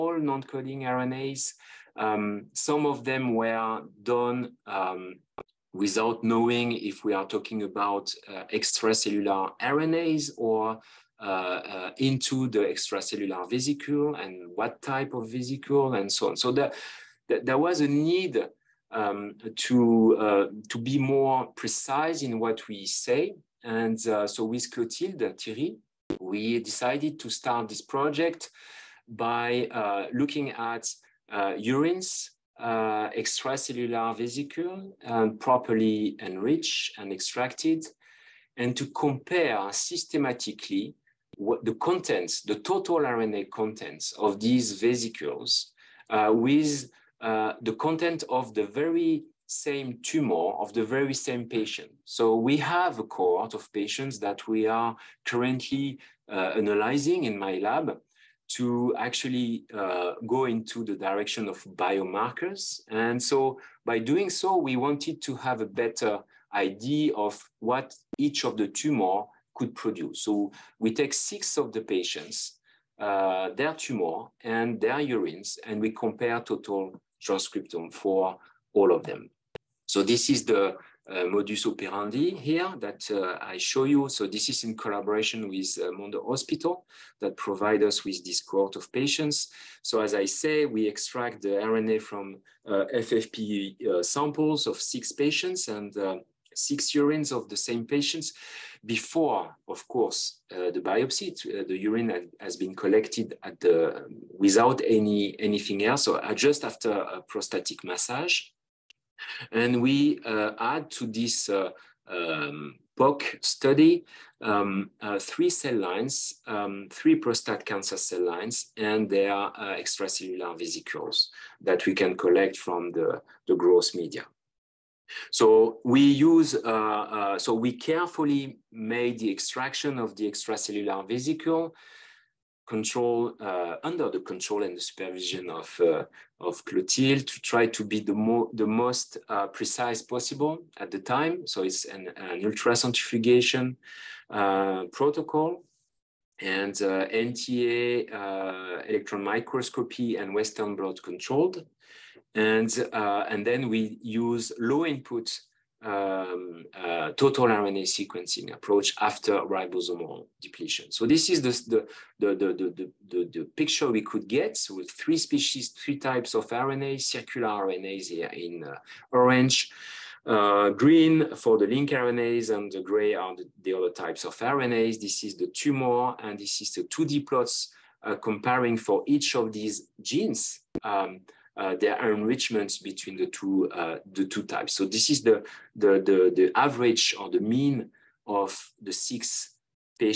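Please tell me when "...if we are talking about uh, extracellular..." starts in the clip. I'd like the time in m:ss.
0:06.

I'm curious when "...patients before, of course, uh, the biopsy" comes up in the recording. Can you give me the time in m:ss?
1:37.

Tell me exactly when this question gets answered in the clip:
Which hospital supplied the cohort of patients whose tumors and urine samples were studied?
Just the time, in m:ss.
1:25.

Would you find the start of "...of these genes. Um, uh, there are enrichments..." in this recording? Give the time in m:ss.
2:59.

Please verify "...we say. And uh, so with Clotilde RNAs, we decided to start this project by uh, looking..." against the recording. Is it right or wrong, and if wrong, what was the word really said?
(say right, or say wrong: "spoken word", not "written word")
wrong: "Théry", not "RNAs".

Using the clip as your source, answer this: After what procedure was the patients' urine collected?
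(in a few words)
Prostatic massage.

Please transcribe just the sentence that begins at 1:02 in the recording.
And so by doing so, we wanted to have a better idea of what each of the tumor could produce.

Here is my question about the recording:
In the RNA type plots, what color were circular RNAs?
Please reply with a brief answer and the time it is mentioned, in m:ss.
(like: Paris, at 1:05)
Orange, at 2:49.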